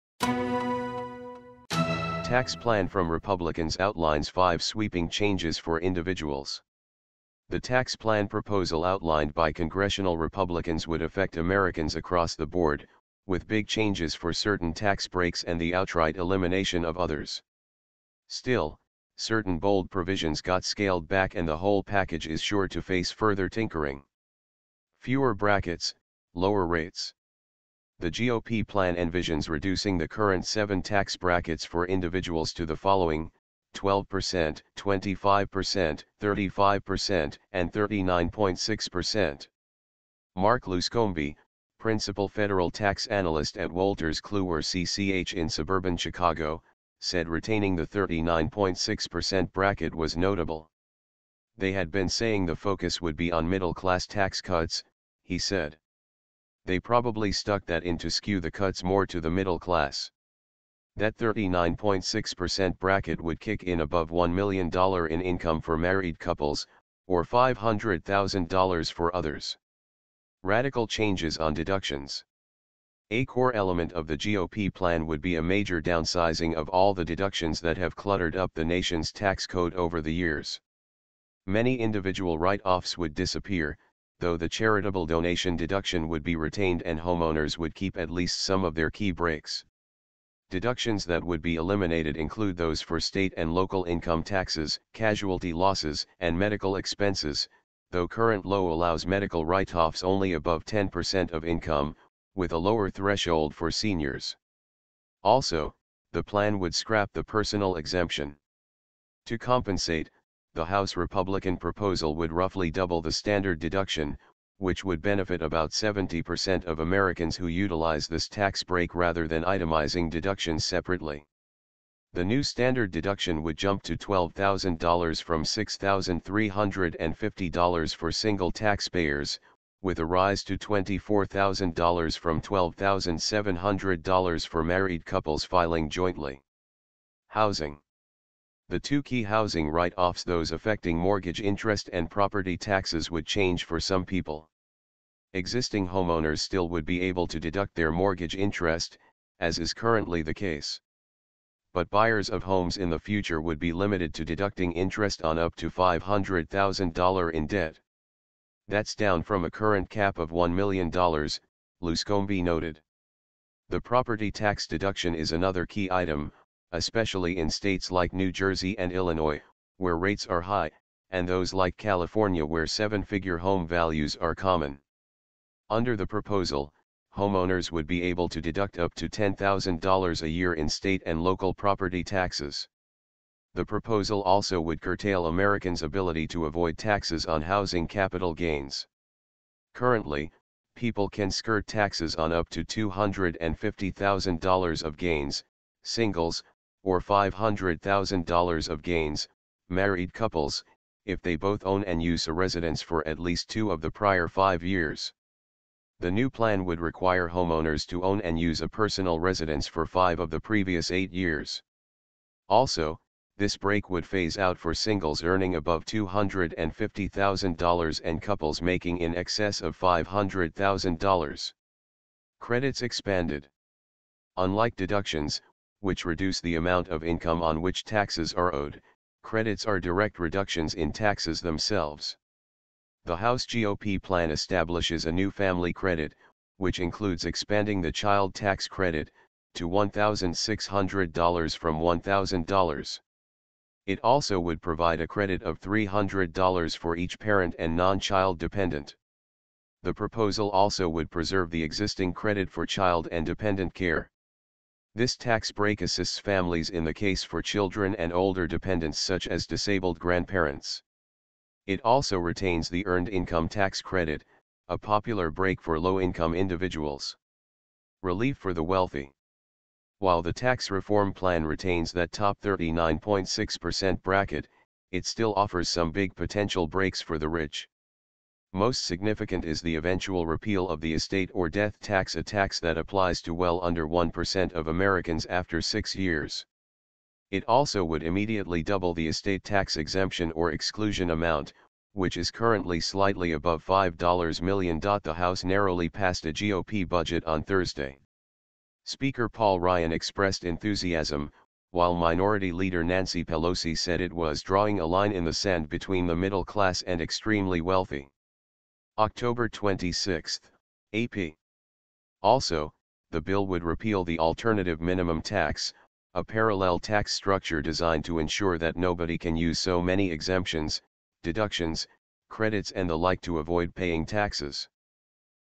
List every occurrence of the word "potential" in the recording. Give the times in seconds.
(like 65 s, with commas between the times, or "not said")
276 s.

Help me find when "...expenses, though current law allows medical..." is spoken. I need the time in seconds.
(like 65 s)
96 s.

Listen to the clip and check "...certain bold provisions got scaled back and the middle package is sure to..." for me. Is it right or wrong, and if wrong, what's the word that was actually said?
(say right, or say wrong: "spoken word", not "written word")
wrong: "whole", not "middle".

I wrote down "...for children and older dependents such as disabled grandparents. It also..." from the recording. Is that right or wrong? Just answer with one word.
right.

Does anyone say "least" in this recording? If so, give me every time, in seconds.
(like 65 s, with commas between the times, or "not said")
88 s, 203 s.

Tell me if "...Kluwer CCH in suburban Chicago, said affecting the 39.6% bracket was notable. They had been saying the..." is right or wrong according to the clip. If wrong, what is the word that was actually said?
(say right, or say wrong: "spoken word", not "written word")
wrong: "retaining", not "affecting".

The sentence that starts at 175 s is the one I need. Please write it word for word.
Under the proposal, homeowners would be able to deduct up to $10,000 a year in state and local property taxes.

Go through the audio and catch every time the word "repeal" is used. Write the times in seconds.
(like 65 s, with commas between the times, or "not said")
280 s, 313 s.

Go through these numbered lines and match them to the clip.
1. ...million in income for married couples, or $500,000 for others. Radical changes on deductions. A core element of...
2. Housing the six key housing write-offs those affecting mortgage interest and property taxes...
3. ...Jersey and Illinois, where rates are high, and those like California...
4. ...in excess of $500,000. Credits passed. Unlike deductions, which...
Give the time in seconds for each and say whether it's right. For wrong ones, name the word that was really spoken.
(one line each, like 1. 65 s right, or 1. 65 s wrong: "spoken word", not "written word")
1. 64 s right
2. 137 s wrong: "two", not "six"
3. 168 s right
4. 218 s wrong: "expanded", not "passed".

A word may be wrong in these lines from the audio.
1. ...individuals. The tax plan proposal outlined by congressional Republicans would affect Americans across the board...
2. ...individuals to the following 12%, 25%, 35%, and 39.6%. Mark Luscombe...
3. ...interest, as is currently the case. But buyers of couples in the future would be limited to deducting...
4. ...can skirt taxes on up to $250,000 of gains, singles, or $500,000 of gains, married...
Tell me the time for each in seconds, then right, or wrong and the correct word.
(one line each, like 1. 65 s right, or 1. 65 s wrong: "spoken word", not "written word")
1. 5 s right
2. 31 s right
3. 148 s wrong: "homes", not "couples"
4. 191 s right.